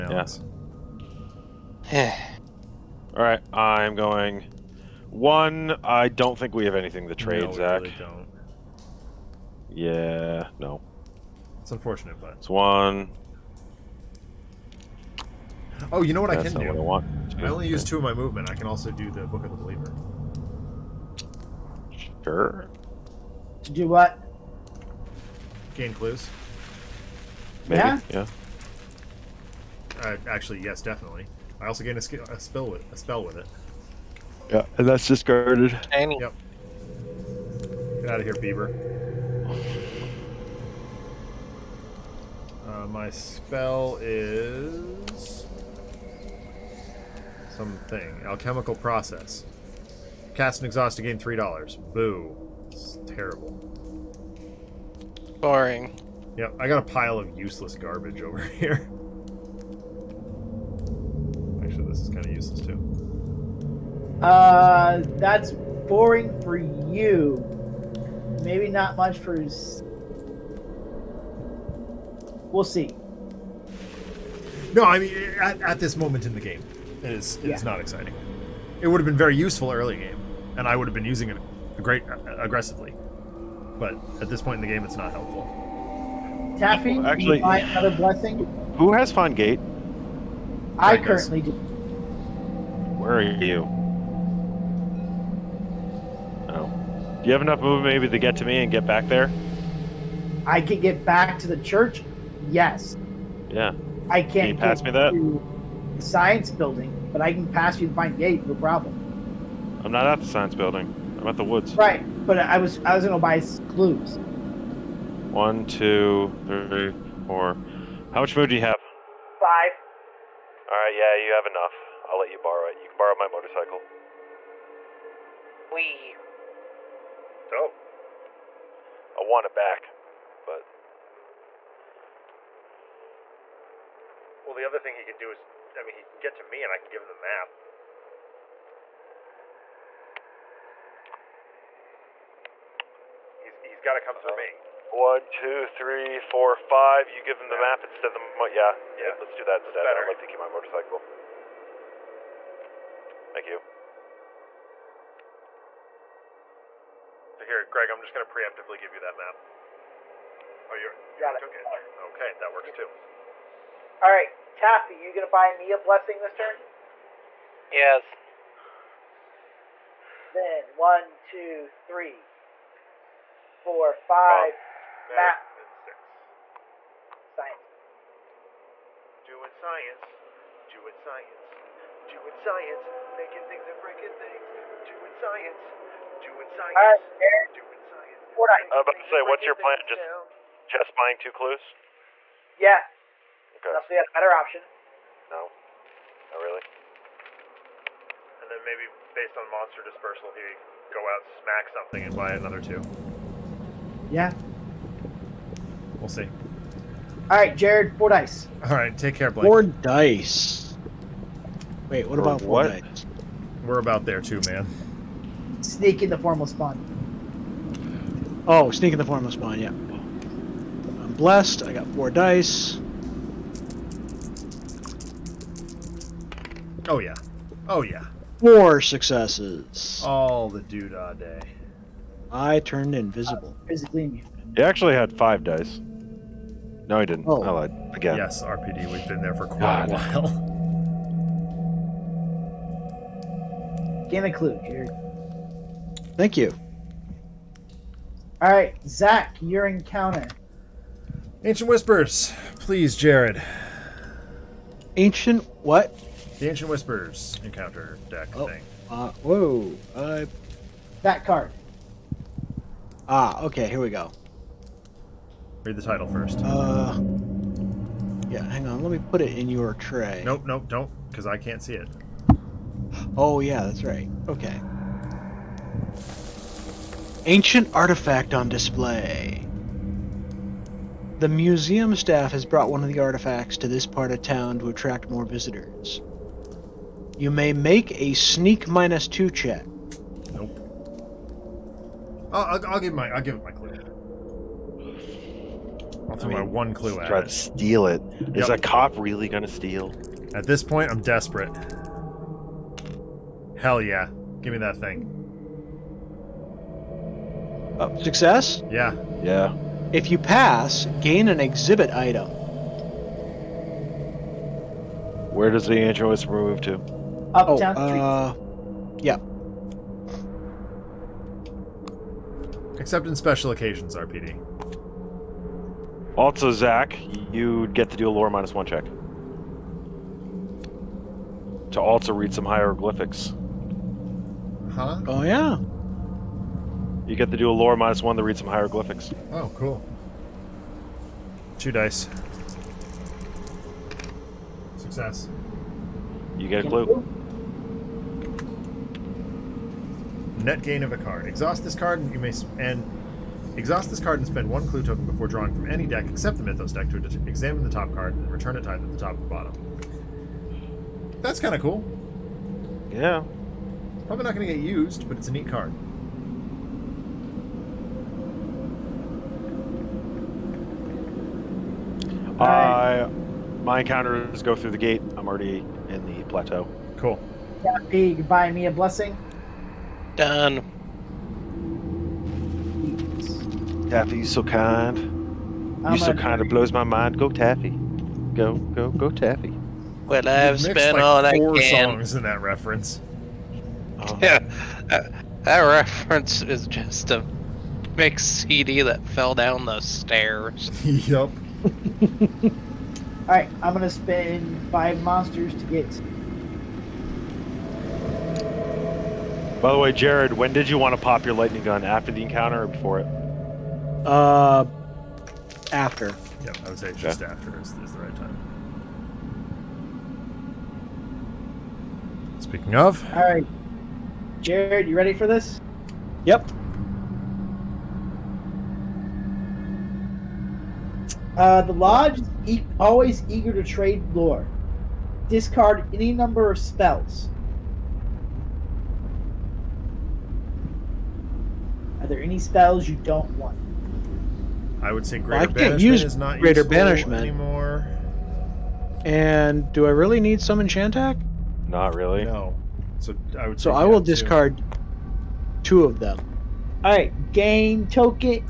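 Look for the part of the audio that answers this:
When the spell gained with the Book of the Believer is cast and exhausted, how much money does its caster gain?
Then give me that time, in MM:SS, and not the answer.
00:51.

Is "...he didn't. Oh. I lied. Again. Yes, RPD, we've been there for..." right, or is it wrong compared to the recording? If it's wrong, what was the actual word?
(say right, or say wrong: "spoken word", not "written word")
right.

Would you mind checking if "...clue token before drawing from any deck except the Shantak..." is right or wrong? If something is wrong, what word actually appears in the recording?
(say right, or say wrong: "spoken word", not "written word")
wrong: "Mythos", not "Shantak".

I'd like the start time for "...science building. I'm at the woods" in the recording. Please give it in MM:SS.
01:50.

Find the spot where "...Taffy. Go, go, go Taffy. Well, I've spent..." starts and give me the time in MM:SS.
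06:27.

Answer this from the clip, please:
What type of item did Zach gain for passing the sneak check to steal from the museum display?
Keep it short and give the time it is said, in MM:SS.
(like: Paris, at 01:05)
exhibit item, at 05:11.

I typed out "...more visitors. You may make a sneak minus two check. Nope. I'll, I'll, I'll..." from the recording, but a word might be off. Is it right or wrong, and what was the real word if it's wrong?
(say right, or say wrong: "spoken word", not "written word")
right.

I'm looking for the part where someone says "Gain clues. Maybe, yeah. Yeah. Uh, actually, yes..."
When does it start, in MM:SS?
00:25.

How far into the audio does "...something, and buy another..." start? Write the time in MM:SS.
03:21.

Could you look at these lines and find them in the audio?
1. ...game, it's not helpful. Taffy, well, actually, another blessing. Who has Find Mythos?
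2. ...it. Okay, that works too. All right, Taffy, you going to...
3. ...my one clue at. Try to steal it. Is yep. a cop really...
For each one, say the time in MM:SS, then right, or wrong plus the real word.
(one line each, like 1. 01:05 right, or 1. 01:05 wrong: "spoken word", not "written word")
1. 01:24 wrong: "Gate", not "Mythos"
2. 02:41 right
3. 04:56 right.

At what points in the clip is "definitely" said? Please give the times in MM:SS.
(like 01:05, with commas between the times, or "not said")
00:30.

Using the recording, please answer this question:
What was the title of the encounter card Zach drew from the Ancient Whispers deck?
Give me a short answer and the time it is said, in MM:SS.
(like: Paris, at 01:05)
Ancient artifact on display, at 04:37.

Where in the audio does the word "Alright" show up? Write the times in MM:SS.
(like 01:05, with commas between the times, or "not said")
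06:43, 07:03.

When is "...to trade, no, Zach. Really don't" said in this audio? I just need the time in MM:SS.
00:07.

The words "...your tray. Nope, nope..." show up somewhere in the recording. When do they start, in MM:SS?
04:29.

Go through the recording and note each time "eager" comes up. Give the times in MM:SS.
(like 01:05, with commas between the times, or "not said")
07:13.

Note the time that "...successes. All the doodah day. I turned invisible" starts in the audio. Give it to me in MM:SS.
03:48.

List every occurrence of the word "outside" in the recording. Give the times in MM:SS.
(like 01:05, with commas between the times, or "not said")
not said.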